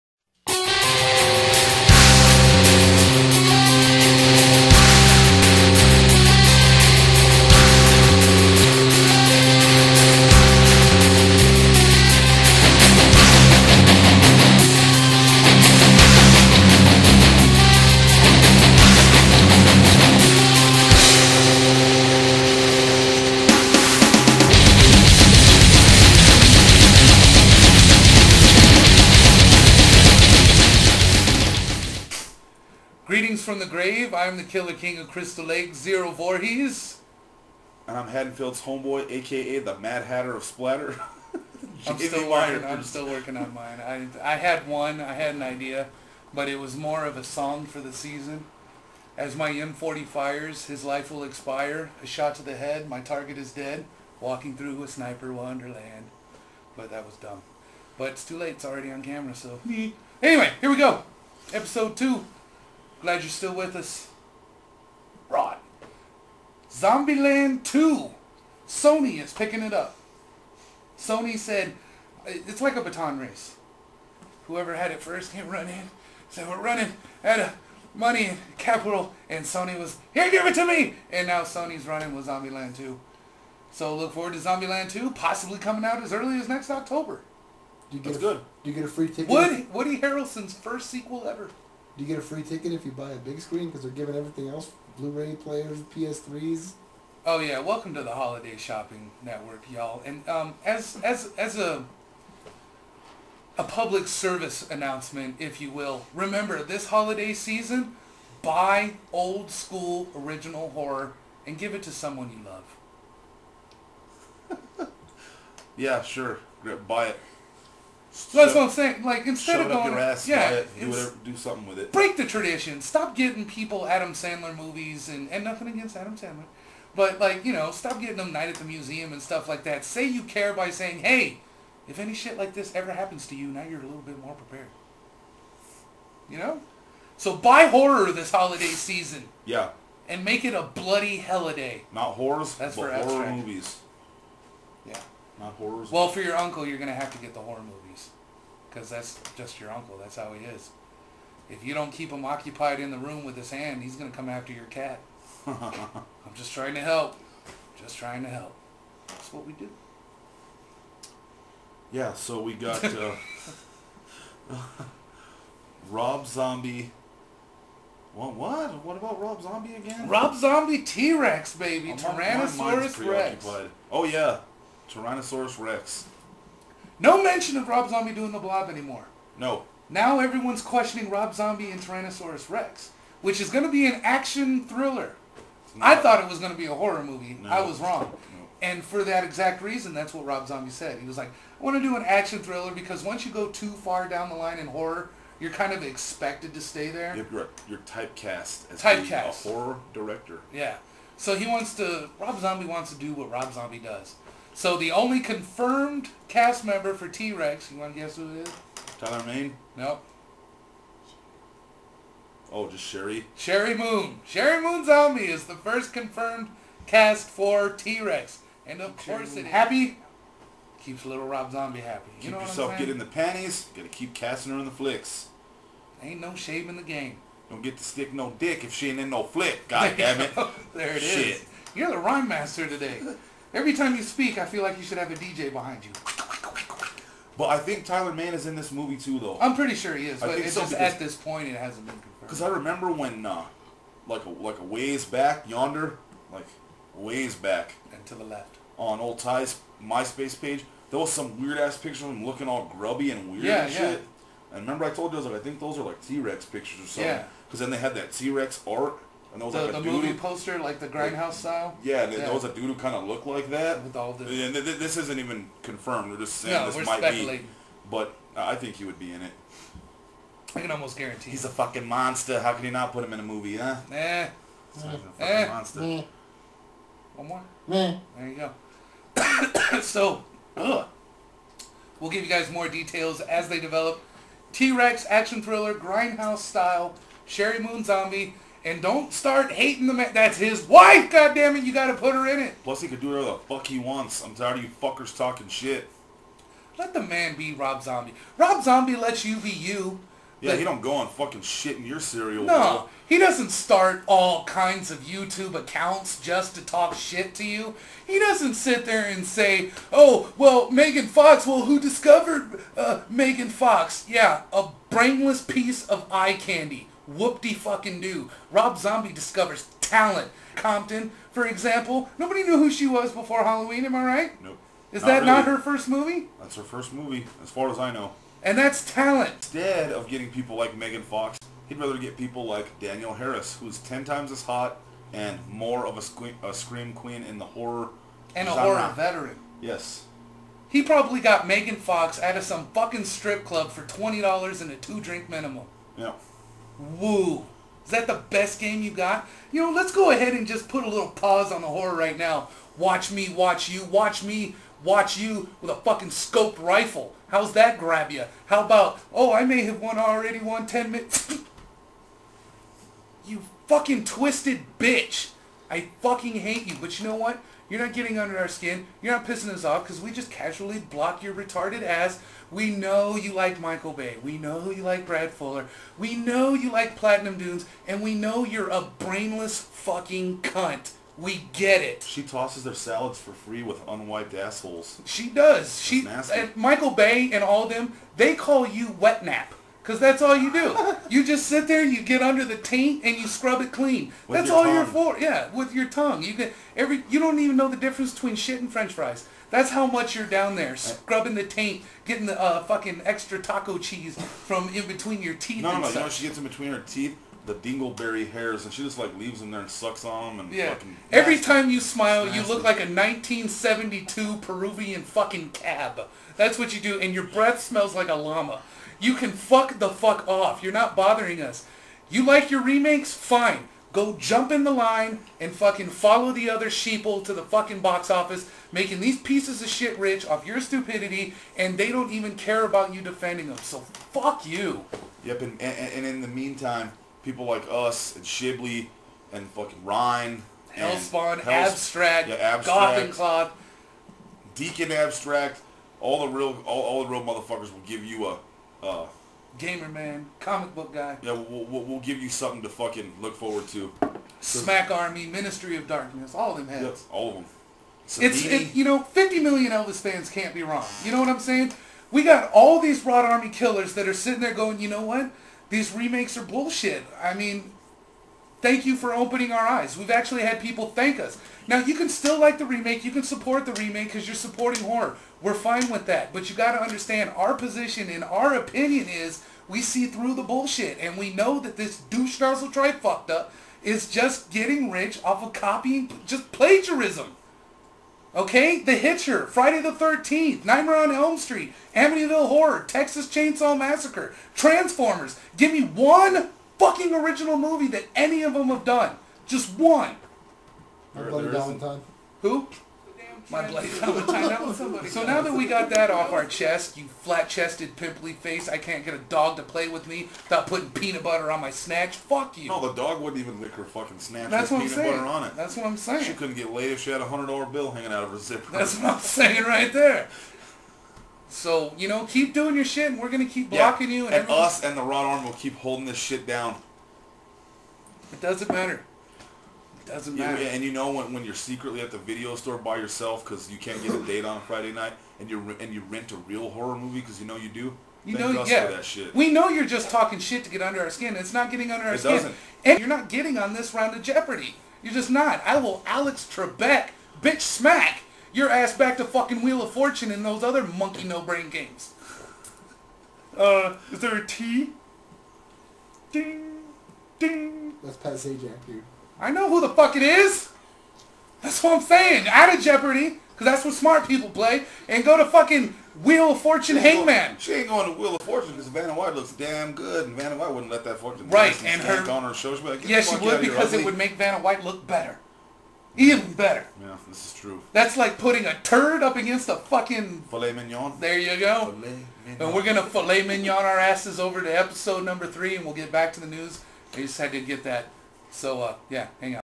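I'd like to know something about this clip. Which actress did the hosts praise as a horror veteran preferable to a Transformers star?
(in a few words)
Danielle Harris.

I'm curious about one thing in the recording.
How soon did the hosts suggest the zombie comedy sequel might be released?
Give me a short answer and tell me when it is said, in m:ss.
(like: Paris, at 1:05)
next October, at 1:26.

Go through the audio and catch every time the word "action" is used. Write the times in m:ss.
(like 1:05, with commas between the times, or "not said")
3:04, 3:12, 4:45.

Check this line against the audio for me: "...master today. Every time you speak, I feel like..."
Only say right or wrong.
right.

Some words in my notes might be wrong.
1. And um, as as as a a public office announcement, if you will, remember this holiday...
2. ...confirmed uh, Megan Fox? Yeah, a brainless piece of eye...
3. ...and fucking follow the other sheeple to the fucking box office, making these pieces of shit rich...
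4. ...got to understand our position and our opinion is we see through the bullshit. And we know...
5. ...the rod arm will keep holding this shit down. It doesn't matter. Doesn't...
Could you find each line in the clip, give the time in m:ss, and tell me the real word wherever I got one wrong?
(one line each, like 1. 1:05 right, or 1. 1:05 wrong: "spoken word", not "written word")
1. 1:40 wrong: "service", not "office"
2. 5:11 wrong: "discovered", not "confirmed"
3. 7:05 right
4. 7:56 right
5. 8:44 right.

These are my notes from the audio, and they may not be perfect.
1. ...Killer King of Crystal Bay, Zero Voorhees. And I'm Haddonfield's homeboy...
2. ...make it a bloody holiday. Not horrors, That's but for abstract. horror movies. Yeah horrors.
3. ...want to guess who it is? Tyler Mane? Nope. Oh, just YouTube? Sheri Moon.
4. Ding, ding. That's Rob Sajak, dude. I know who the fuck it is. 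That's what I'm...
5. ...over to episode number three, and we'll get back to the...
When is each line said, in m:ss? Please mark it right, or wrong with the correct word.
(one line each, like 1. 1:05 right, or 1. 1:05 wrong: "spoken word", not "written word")
1. 0:34 wrong: "Lake", not "Bay"
2. 2:20 right
3. 3:27 wrong: "Sheri", not "YouTube"
4. 9:16 wrong: "Pat", not "Rob"
5. 9:44 right.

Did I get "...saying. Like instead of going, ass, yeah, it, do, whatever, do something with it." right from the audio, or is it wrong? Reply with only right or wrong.
right.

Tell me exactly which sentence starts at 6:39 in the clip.
That's how much you're down there uh, scrubbing the taint, getting the uh, fucking extra taco cheese from in between your teeth.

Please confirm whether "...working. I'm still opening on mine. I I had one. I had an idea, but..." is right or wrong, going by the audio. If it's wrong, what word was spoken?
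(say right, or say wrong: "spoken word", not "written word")
wrong: "working", not "opening".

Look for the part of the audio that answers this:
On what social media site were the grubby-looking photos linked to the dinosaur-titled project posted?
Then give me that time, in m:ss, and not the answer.
4:09.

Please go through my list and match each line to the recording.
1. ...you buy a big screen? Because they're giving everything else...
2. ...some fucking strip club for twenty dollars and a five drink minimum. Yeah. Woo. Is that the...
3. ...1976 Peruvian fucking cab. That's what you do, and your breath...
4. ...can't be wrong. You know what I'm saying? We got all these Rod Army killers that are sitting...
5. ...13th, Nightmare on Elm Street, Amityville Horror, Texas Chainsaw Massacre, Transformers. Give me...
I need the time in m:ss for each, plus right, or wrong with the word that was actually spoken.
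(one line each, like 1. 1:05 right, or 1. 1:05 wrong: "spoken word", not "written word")
1. 1:32 right
2. 5:42 wrong: "two", not "five"
3. 6:52 wrong: "1972", not "1976"
4. 7:40 right
5. 8:09 right.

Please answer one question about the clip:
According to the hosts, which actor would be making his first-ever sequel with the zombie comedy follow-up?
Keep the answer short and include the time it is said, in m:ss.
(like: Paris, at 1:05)
Woody Harrelson, at 1:29.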